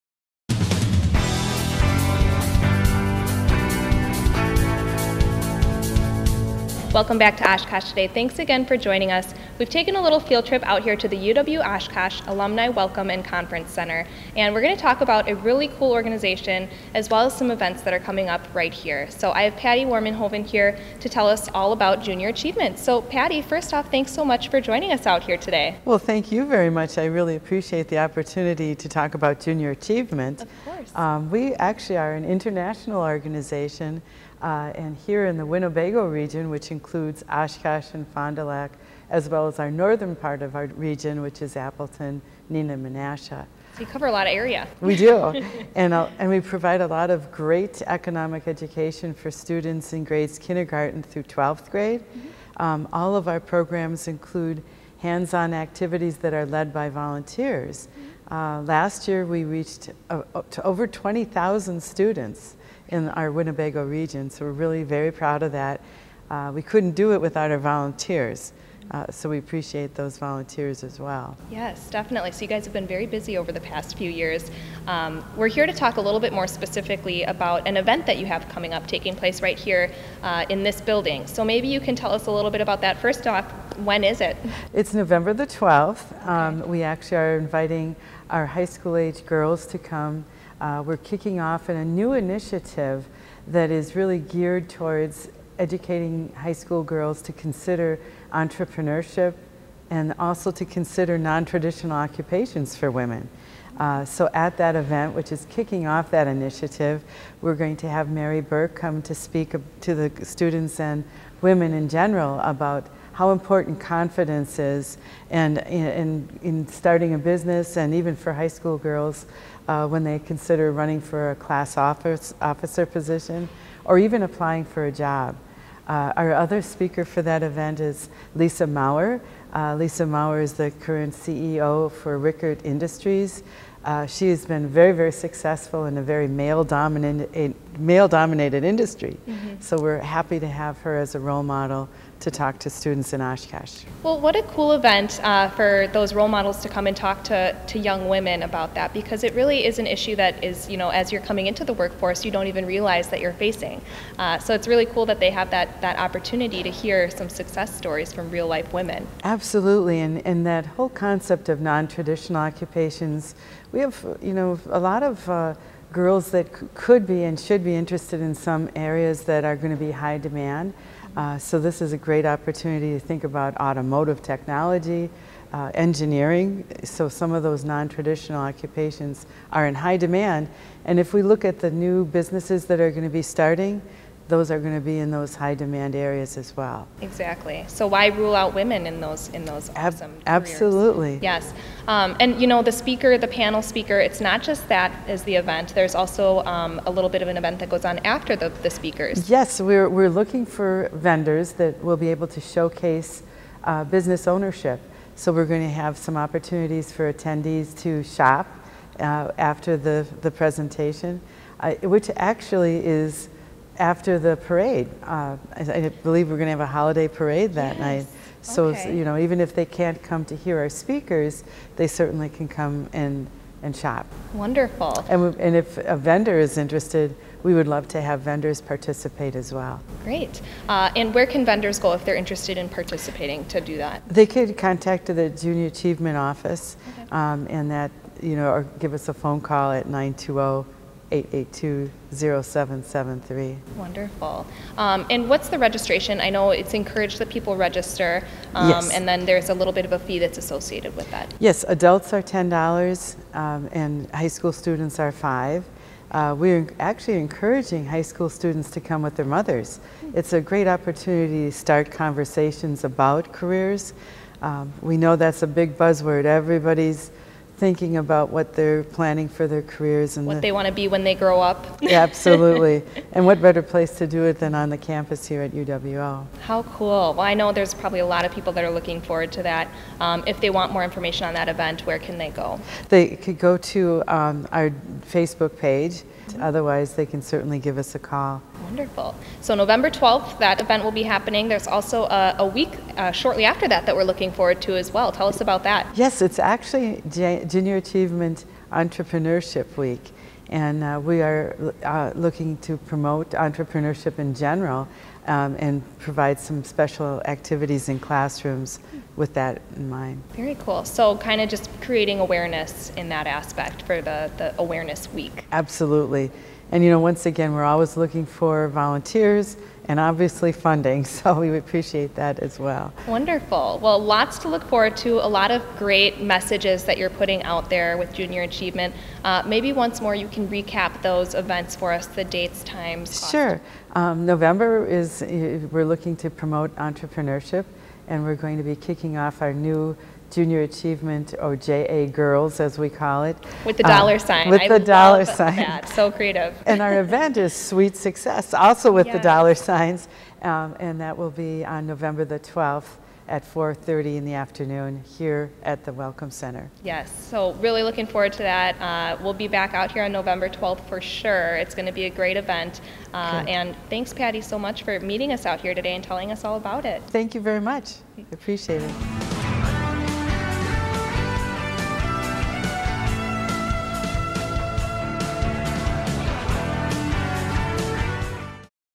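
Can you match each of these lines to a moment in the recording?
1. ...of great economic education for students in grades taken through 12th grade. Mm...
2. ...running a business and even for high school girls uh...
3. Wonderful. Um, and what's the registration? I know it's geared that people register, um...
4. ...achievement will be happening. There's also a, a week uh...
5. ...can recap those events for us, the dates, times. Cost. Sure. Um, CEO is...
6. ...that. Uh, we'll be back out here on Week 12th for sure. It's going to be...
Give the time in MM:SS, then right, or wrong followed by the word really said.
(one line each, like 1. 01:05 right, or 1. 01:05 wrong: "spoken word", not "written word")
1. 00:47 wrong: "kindergarten", not "taken"
2. 01:56 wrong: "starting", not "running"
3. 04:03 wrong: "encouraged", not "geared"
4. 04:50 wrong: "event", not "achievement"
5. 05:30 wrong: "November", not "CEO"
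6. 05:58 wrong: "November", not "Week".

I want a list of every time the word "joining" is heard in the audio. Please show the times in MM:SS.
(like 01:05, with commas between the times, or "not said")
00:08, 00:24.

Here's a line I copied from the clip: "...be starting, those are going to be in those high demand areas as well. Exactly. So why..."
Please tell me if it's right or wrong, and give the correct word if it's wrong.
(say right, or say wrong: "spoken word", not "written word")
right.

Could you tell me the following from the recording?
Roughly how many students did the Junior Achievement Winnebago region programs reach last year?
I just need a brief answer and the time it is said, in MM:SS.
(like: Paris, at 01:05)
over 20,000, at 01:00.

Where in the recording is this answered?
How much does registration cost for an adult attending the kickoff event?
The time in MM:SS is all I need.
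04:12.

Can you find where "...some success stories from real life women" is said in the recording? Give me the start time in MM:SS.
02:37.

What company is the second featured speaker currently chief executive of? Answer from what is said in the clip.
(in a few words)
Rickard Industries.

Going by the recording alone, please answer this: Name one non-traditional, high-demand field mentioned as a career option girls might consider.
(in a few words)
automotive technology.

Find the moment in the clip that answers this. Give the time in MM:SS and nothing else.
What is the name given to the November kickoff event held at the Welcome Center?
05:47.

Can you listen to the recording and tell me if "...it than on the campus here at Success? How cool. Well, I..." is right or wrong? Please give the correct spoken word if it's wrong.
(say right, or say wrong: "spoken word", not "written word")
wrong: "UWL", not "Success".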